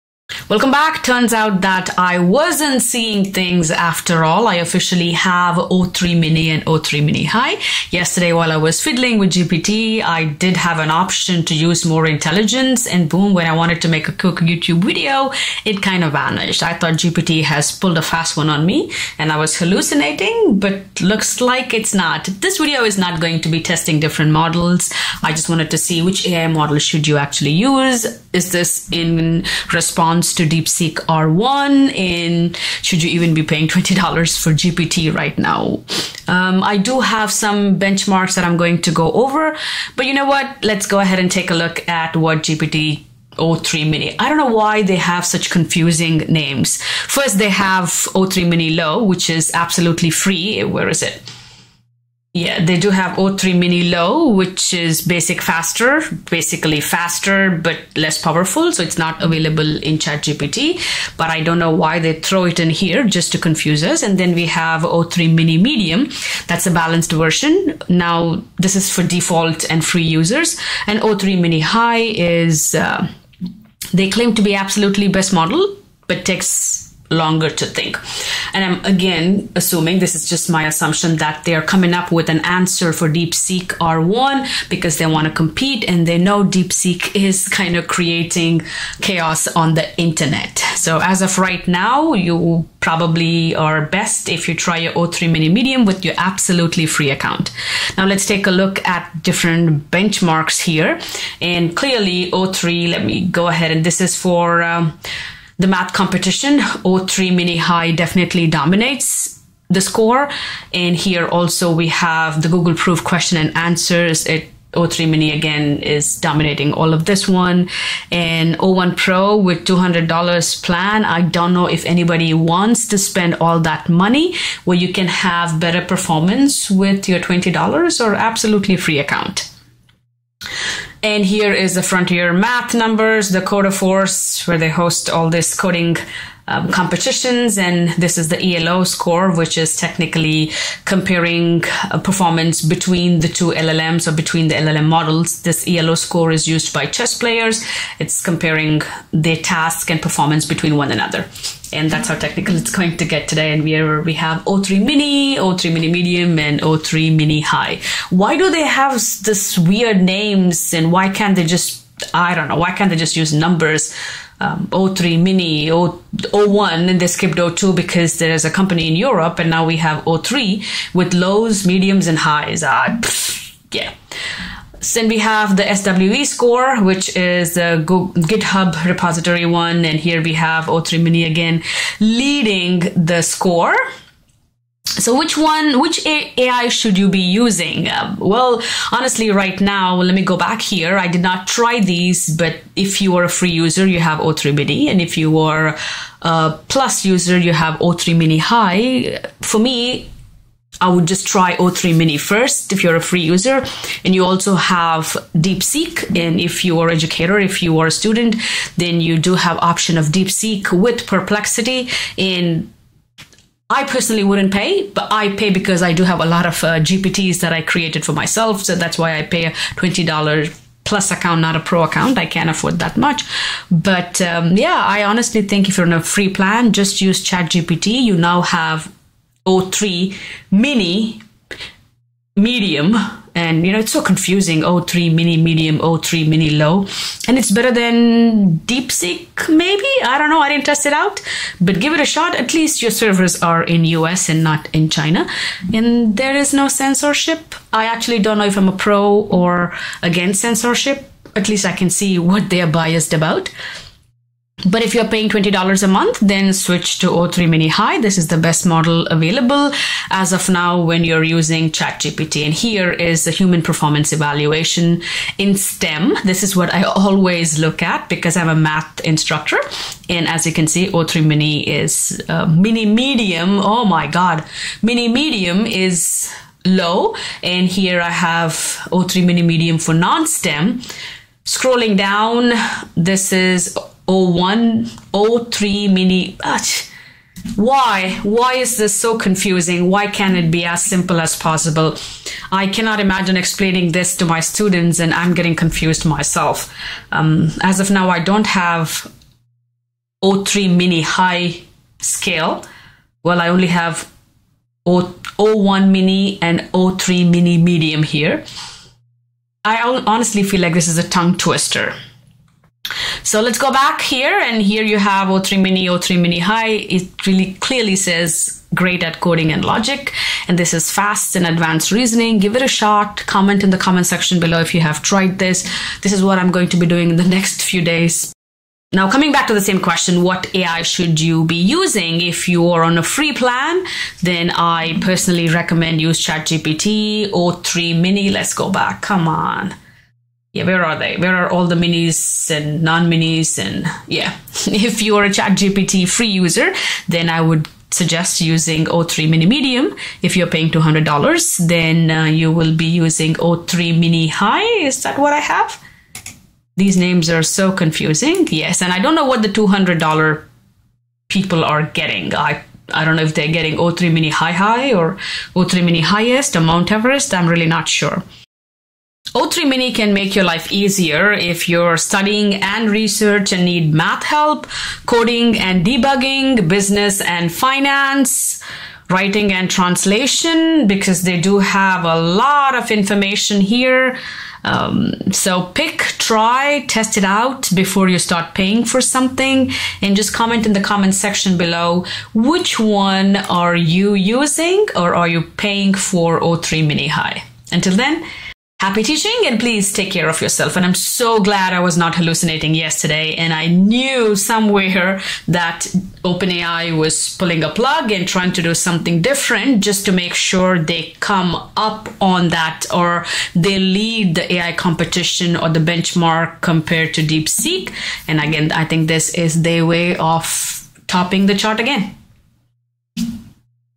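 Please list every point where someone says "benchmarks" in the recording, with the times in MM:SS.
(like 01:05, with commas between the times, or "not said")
00:37, 01:39, 06:55.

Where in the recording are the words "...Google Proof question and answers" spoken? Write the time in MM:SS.
01:52.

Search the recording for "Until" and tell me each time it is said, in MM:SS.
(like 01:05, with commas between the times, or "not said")
06:37.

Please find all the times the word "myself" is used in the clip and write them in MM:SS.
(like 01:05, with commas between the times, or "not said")
03:38, 04:56.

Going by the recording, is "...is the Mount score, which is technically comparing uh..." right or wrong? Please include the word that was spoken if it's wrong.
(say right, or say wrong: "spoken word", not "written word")
wrong: "ELO", not "Mount".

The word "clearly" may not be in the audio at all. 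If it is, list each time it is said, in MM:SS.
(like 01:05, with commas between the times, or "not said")
01:41, 05:17.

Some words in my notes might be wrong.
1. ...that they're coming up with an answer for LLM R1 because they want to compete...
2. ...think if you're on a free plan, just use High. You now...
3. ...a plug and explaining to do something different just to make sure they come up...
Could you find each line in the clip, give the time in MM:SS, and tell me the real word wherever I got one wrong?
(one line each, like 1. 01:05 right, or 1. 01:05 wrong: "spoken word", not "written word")
1. 01:21 wrong: "DeepSeek", not "LLM"
2. 03:45 wrong: "ChatGPT", not "High"
3. 06:47 wrong: "trying", not "explaining".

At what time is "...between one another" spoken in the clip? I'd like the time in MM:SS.
02:30.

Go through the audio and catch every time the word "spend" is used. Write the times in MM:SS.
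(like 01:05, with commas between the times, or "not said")
02:02.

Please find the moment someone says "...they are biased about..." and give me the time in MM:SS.
04:12.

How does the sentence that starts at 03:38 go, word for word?
So that's why I pay a $20 plus account, not a pro account.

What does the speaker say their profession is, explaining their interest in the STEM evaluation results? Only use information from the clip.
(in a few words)
Math instructor.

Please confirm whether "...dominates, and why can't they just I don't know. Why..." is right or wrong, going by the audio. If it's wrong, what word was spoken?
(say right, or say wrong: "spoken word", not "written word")
wrong: "names", not "dominates".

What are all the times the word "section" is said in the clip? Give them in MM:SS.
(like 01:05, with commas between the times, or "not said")
05:24, 06:31.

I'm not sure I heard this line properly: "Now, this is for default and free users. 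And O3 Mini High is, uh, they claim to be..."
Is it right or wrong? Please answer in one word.
right.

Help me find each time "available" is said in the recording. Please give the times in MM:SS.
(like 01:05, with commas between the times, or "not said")
00:59, 04:19.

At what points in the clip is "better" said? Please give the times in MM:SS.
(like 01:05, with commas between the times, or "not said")
02:05, 03:57.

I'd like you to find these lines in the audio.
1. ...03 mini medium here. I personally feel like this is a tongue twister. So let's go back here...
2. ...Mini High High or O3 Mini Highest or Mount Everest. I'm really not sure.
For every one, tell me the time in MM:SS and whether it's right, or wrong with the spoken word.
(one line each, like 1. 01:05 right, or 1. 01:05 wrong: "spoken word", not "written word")
1. 05:06 wrong: "honestly", not "personally"
2. 06:04 right.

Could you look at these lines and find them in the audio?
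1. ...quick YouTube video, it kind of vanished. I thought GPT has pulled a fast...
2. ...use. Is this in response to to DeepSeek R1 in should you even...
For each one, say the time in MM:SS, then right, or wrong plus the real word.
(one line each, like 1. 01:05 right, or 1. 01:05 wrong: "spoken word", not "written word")
1. 00:14 right
2. 00:27 right.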